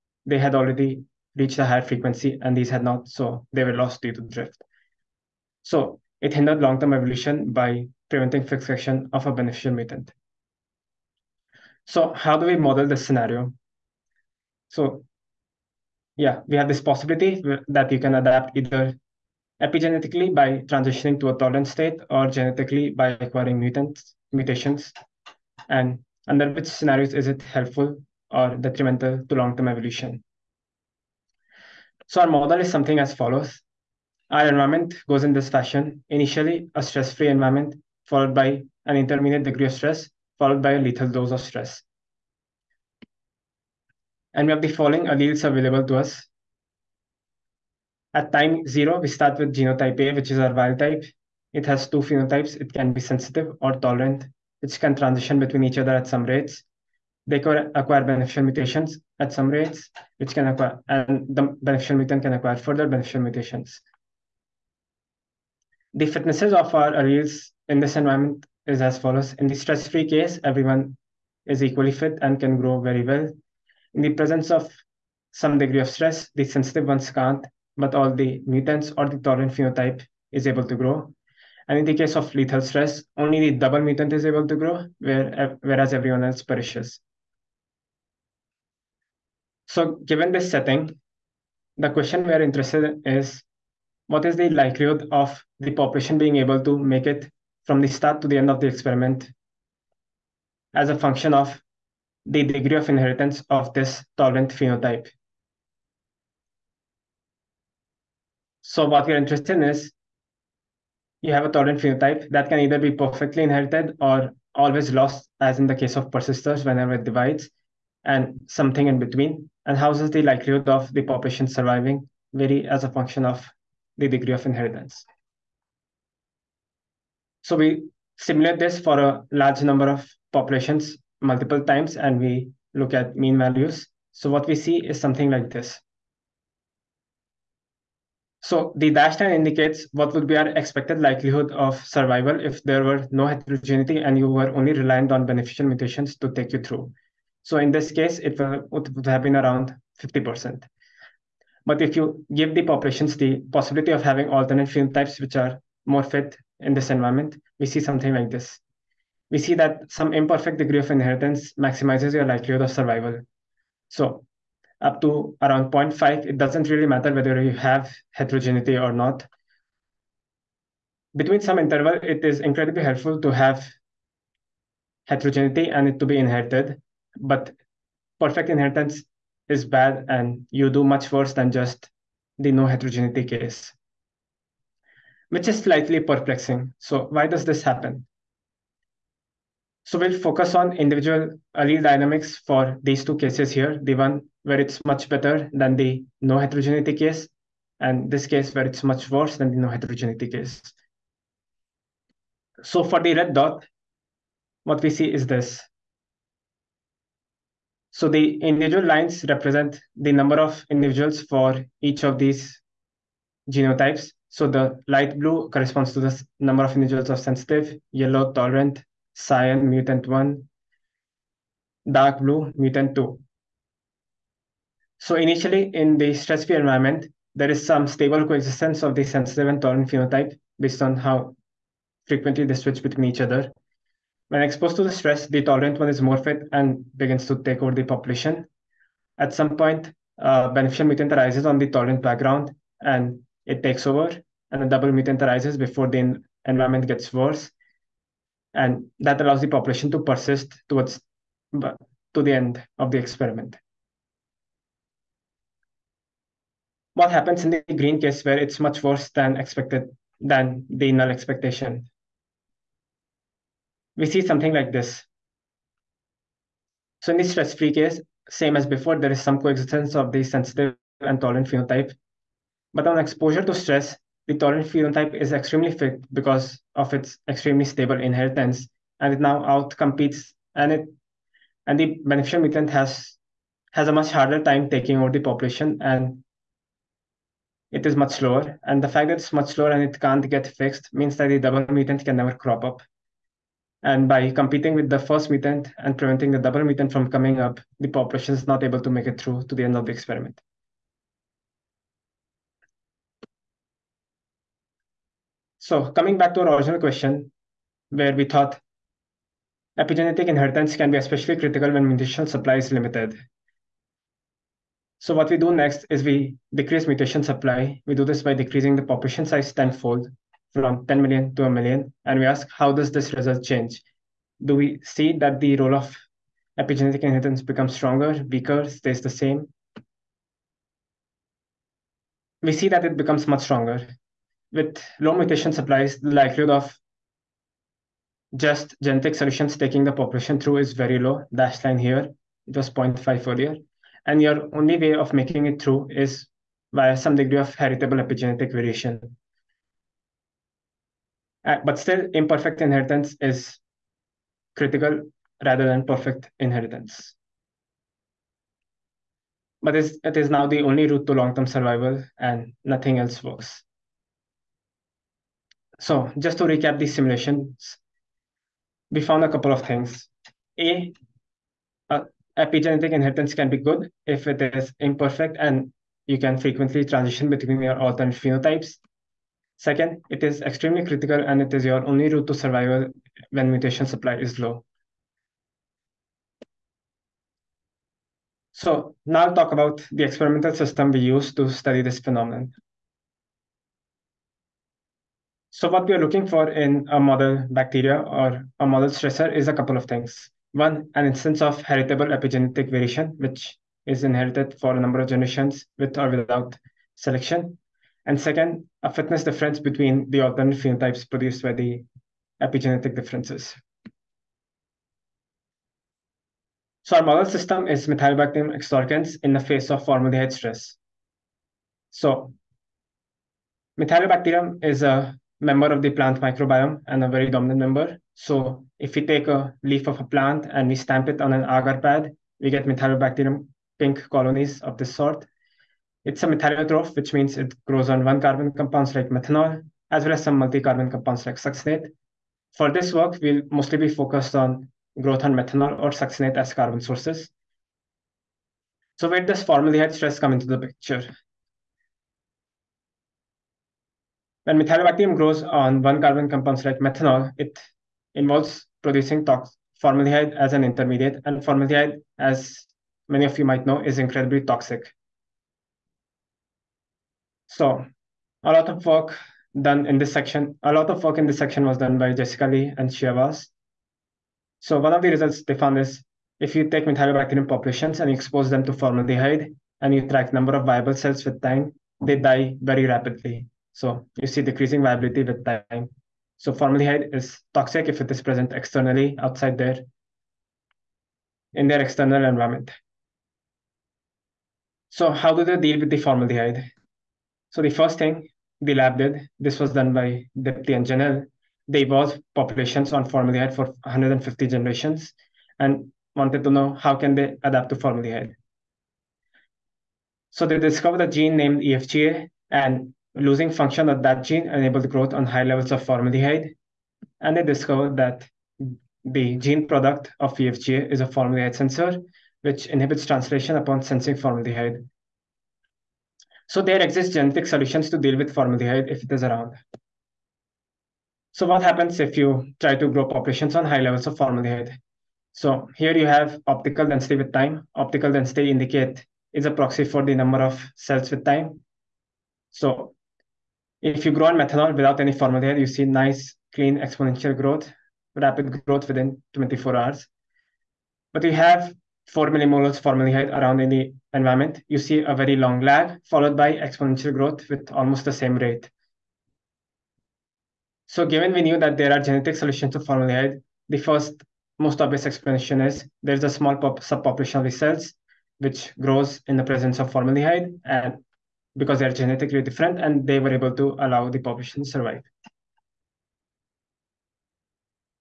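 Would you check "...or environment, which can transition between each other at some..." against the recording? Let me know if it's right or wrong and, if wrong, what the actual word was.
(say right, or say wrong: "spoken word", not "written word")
wrong: "tolerant", not "environment".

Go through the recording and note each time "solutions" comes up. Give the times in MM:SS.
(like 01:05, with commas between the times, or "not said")
05:39, 08:47, 09:22.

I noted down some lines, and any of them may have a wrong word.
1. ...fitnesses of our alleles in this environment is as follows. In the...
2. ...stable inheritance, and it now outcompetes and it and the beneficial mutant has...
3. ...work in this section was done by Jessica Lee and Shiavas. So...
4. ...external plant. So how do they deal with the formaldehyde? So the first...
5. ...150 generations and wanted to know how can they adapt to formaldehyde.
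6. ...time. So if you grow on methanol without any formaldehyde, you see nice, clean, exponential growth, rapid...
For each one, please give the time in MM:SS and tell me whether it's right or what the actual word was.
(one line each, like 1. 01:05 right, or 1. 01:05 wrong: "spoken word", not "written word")
1. 01:06 right
2. 04:37 right
3. 07:51 right
4. 08:11 wrong: "environment", not "plant"
5. 08:23 right
6. 09:01 right.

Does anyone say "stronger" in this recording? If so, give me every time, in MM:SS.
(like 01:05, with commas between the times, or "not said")
05:27, 05:33.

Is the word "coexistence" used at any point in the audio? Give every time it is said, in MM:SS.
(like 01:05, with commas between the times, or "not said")
03:48, 04:29.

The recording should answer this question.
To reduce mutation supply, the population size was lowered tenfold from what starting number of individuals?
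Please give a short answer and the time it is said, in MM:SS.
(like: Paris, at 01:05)
10 million, at 05:20.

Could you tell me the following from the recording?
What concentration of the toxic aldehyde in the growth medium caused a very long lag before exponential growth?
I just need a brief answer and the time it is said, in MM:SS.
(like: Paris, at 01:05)
4 millimolar, at 09:12.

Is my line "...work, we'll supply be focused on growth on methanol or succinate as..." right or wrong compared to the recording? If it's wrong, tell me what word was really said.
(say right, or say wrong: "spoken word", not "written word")
wrong: "mostly", not "supply".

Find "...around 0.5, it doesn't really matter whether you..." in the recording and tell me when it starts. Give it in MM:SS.
02:45.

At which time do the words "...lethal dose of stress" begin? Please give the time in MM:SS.
00:40.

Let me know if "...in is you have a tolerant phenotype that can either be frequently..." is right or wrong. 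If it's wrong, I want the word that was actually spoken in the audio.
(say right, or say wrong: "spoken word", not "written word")
wrong: "perfectly", not "frequently".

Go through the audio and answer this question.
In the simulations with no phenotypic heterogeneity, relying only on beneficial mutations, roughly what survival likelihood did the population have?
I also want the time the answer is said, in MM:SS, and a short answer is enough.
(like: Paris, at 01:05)
50%, at 02:29.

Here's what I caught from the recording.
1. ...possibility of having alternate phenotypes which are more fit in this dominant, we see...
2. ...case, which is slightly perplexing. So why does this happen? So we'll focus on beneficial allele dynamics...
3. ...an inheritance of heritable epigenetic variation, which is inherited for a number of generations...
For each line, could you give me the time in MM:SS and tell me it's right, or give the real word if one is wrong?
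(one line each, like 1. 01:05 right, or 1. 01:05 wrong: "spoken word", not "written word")
1. 02:33 wrong: "environment", not "dominant"
2. 03:03 wrong: "individual", not "beneficial"
3. 06:40 wrong: "instance", not "inheritance".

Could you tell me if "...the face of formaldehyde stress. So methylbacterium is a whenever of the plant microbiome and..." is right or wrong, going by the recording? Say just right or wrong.
wrong.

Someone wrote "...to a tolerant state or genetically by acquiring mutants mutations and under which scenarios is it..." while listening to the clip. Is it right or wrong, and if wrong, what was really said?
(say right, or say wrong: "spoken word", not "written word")
right.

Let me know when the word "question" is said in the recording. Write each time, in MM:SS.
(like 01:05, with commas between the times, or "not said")
01:31, 05:06.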